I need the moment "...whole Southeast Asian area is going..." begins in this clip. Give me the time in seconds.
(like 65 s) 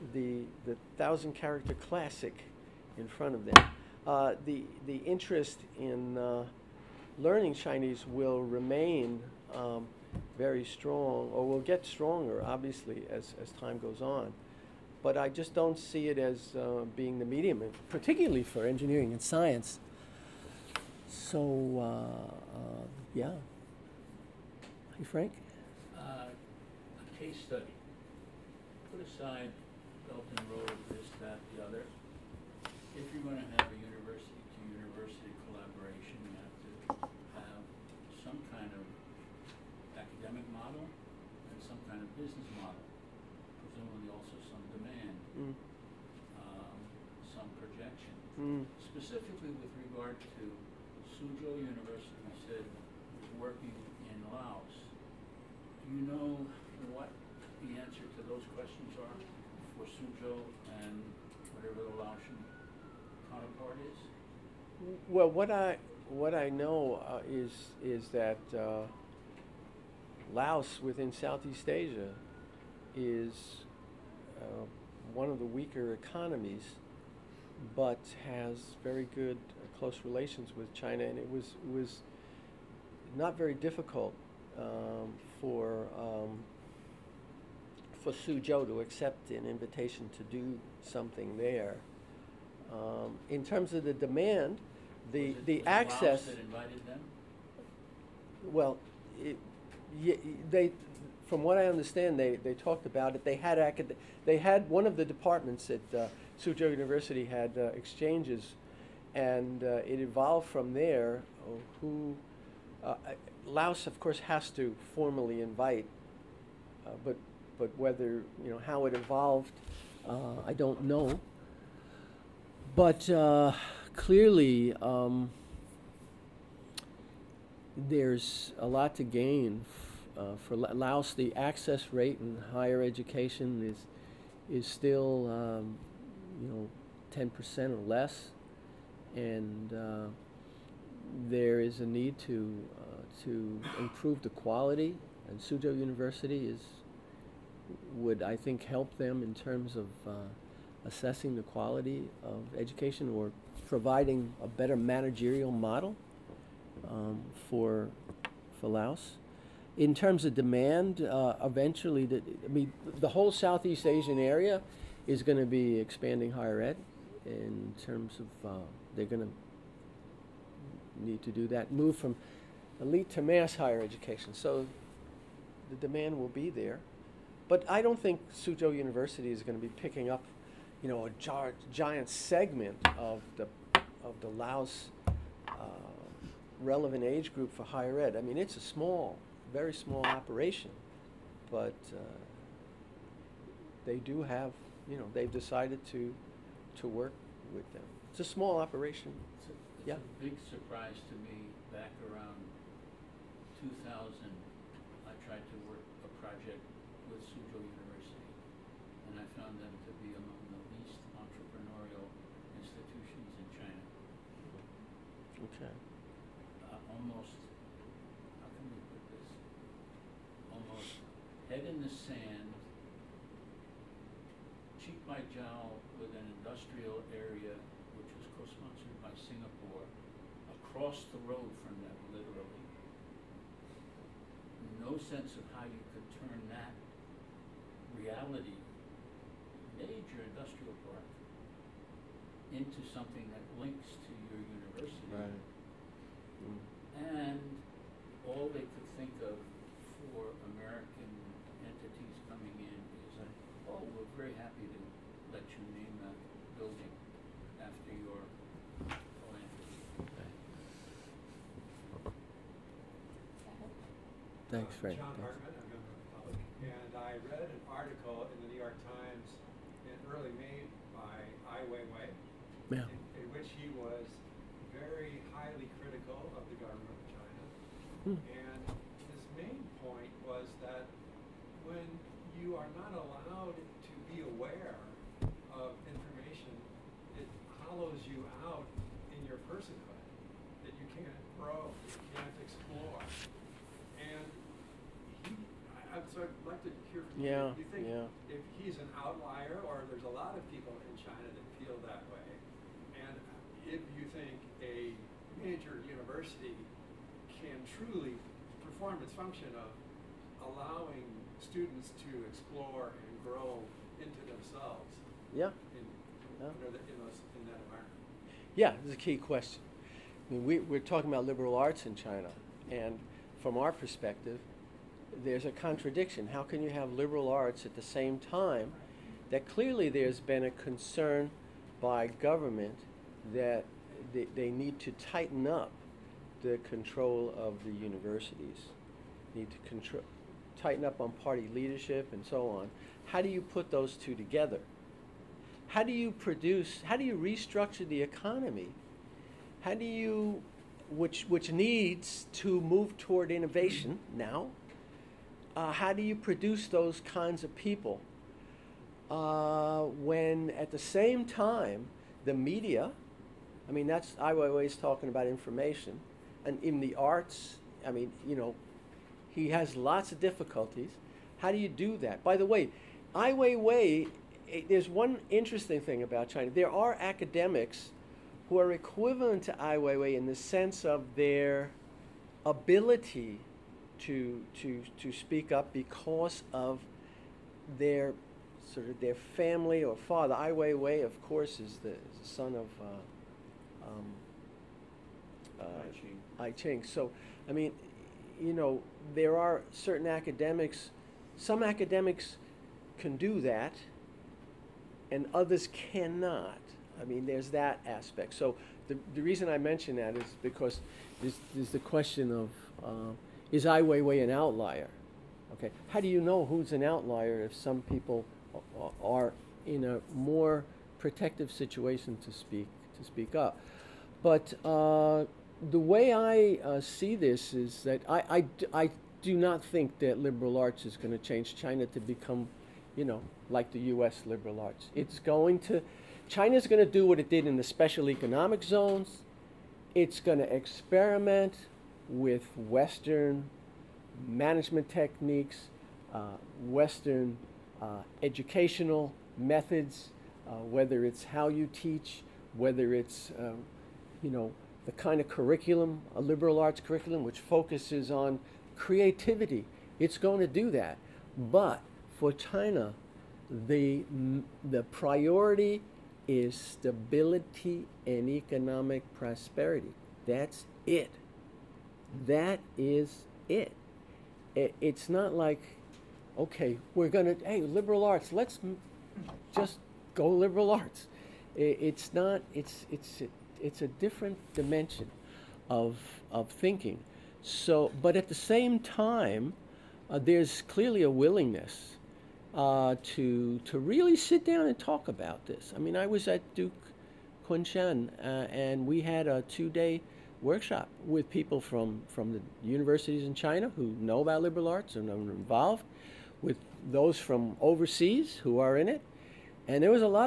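163 s.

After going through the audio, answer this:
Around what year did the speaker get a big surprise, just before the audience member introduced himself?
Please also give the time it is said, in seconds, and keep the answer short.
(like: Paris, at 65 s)
2000, at 203 s.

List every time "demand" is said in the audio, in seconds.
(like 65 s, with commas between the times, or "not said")
93 s, 160 s, 175 s.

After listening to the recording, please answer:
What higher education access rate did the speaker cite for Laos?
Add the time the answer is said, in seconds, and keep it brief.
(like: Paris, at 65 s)
10% or less, at 137 s.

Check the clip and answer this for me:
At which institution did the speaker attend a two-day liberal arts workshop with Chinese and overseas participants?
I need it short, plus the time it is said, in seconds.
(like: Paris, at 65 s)
Duke Kunshan, at 496 s.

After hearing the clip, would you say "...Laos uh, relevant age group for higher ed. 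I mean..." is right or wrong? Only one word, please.
right.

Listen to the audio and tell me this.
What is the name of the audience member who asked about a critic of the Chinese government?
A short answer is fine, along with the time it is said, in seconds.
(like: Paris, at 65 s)
John Hartman, at 264 s.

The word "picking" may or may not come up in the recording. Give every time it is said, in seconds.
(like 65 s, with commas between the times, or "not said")
179 s.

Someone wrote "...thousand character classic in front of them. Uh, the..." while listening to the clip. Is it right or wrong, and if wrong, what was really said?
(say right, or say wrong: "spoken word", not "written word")
right.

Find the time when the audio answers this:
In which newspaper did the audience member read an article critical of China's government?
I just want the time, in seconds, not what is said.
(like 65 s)
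268 s.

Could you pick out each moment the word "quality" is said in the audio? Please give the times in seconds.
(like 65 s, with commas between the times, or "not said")
144 s, 151 s.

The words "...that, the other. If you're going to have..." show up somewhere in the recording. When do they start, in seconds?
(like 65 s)
31 s.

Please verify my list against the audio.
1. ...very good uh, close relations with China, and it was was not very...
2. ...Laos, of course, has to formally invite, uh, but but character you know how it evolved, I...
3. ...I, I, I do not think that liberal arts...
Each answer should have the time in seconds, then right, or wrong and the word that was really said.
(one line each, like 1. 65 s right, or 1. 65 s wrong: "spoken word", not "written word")
1. 78 s right
2. 113 s wrong: "whether", not "character"
3. 428 s right.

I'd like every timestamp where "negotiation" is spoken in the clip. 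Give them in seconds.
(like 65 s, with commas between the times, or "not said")
not said.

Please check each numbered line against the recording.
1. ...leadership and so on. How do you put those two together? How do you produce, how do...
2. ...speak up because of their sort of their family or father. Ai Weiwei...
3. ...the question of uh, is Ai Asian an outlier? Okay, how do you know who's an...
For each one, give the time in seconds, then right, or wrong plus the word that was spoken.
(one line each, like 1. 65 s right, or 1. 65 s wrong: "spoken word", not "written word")
1. 341 s right
2. 385 s right
3. 411 s wrong: "Weiwei", not "Asian".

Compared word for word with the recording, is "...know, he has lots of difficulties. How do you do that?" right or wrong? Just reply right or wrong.
right.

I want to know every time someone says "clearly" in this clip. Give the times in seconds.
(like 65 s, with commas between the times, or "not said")
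123 s, 329 s, 490 s.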